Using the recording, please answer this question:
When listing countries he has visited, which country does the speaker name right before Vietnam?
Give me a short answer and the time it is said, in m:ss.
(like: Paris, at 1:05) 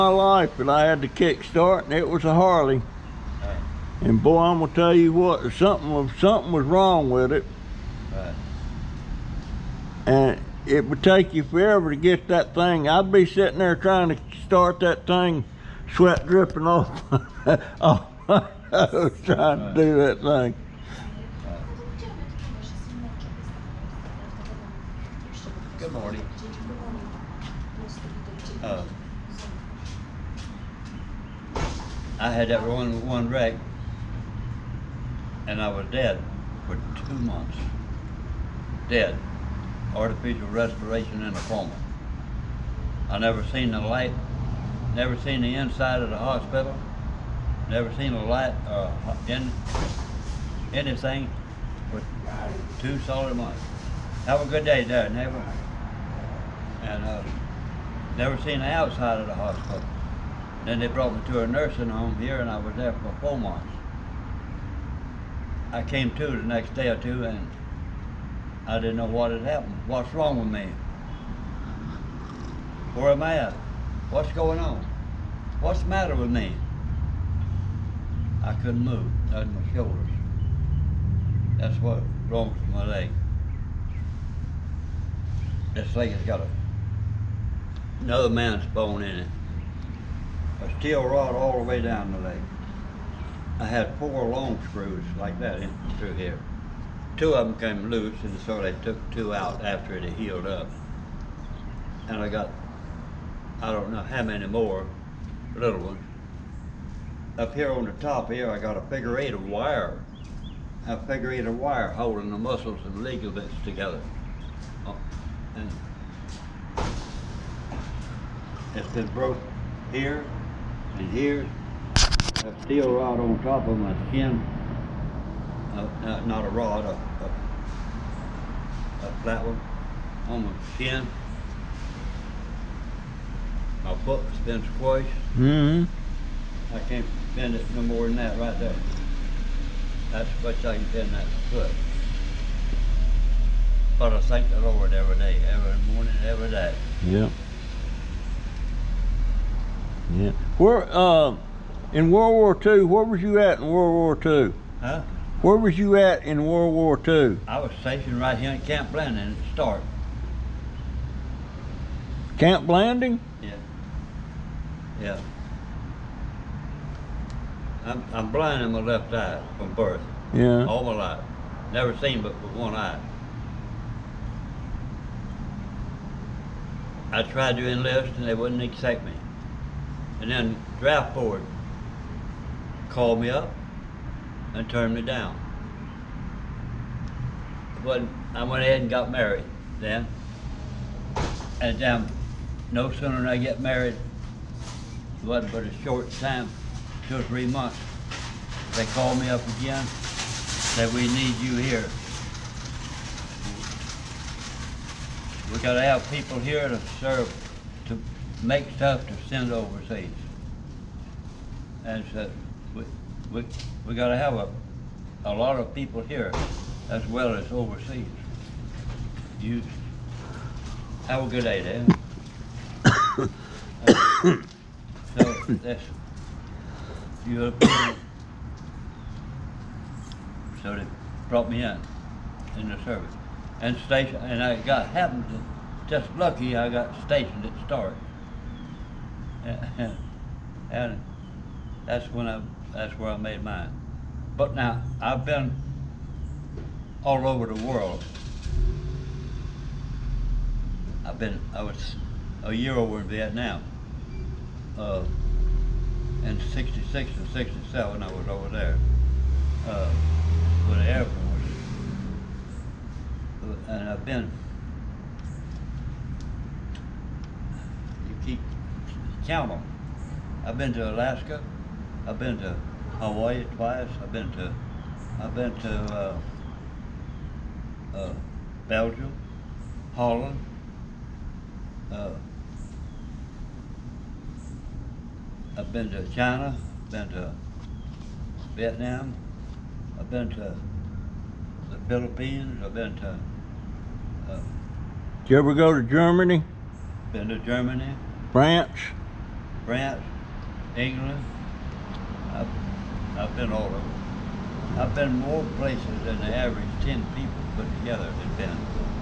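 China, at 4:46.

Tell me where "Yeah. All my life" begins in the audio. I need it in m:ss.
2:50.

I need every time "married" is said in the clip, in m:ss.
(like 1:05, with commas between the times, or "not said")
3:09, 3:13.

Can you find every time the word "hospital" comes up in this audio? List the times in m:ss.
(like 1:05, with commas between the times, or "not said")
0:46, 0:59.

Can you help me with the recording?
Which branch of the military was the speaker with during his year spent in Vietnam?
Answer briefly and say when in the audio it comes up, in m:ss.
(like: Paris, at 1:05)
Air Force, at 4:20.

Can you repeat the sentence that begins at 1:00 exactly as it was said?
Then they brought me to a nursing home here and I was there for four months.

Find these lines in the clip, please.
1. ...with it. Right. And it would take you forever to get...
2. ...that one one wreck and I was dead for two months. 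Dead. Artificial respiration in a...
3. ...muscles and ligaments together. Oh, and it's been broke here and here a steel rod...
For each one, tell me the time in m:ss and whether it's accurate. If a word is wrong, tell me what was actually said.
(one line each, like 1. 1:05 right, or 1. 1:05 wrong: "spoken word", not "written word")
1. 0:07 right
2. 0:32 right
3. 1:52 right.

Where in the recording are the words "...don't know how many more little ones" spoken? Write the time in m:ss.
1:43.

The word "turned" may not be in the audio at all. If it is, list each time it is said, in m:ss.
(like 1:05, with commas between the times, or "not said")
3:04.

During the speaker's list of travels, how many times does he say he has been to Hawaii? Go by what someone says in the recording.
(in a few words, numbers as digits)
twice.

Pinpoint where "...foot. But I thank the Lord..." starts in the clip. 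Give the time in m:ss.
2:21.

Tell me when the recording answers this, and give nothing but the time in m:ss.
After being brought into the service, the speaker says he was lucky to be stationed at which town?
3:57.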